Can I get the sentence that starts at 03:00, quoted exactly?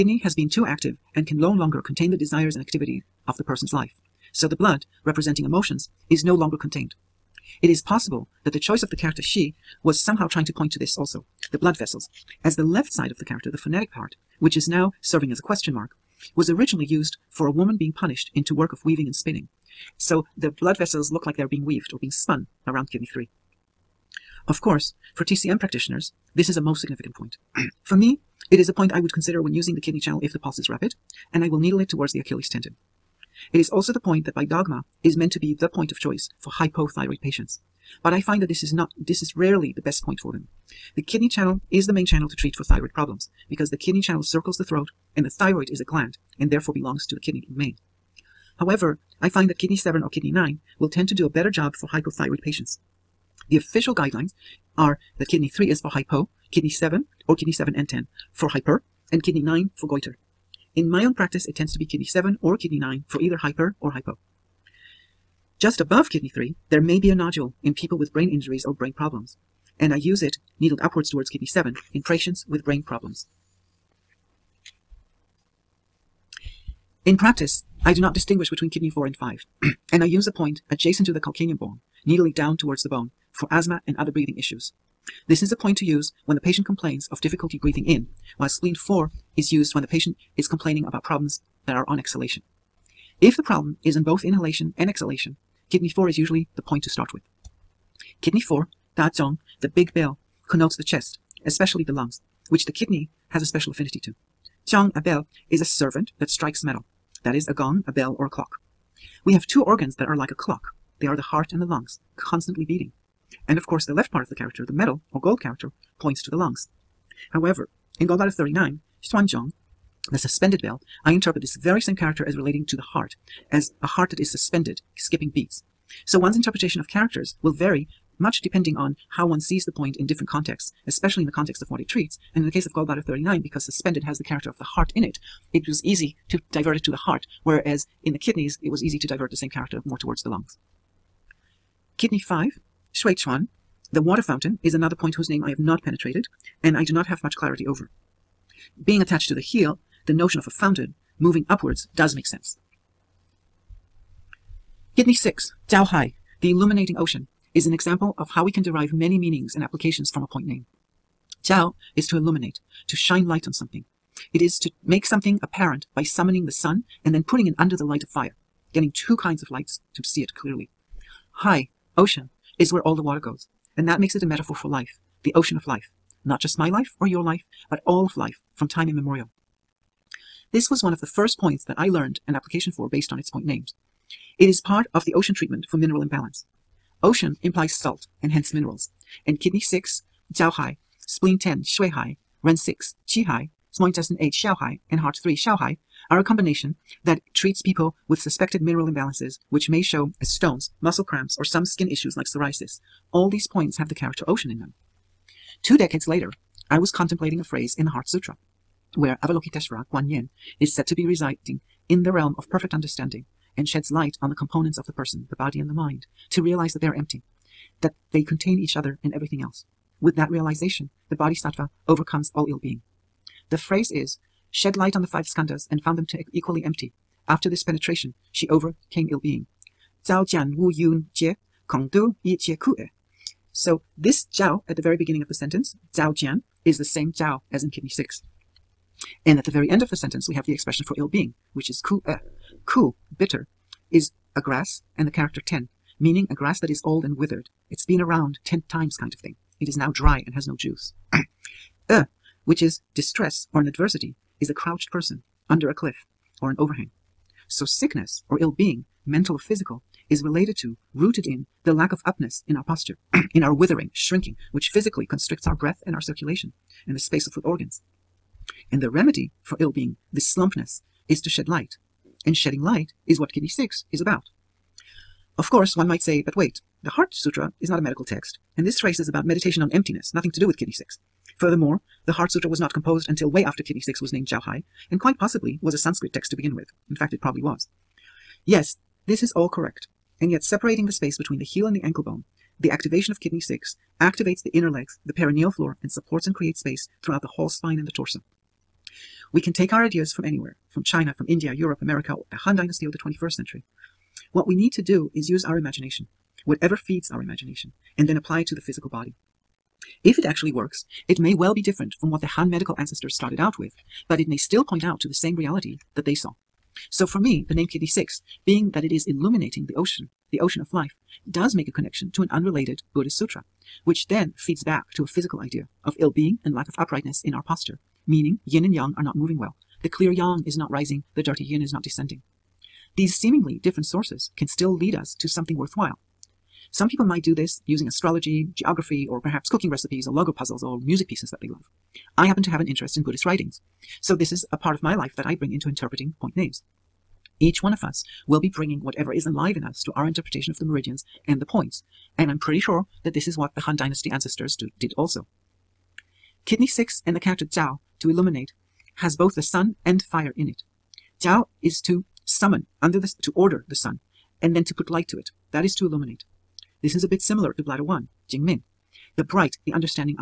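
This was one of the first points that I learned an application for based on its point names.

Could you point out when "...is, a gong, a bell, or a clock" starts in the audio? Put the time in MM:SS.
01:47.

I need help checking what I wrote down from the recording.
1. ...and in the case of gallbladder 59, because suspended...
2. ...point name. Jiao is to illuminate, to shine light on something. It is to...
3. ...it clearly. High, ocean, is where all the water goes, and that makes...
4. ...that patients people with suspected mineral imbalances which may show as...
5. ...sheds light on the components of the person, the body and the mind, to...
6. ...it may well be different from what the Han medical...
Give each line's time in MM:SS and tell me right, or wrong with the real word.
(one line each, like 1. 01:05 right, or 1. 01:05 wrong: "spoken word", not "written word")
1. 02:12 wrong: "39", not "59"
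2. 02:40 right
3. 02:50 right
4. 03:17 wrong: "treats", not "patients"
5. 03:33 right
6. 05:11 right.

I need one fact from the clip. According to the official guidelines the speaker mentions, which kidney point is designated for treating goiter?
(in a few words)
Kidney 9.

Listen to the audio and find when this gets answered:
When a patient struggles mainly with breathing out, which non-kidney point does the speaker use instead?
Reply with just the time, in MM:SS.
01:28.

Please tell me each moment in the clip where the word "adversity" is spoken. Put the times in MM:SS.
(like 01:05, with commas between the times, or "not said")
04:13.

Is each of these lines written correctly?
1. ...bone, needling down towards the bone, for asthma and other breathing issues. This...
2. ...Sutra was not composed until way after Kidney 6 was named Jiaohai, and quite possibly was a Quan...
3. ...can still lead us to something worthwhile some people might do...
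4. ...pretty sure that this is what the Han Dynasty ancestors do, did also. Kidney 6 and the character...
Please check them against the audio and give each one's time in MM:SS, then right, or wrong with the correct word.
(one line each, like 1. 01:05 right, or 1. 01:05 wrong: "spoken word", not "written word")
1. 01:21 right
2. 04:42 wrong: "Sanskrit", not "Quan"
3. 05:34 right
4. 05:52 right.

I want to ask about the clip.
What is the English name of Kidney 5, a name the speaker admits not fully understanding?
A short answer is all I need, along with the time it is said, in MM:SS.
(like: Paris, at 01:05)
the water fountain, at 02:23.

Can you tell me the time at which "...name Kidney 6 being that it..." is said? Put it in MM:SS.
05:17.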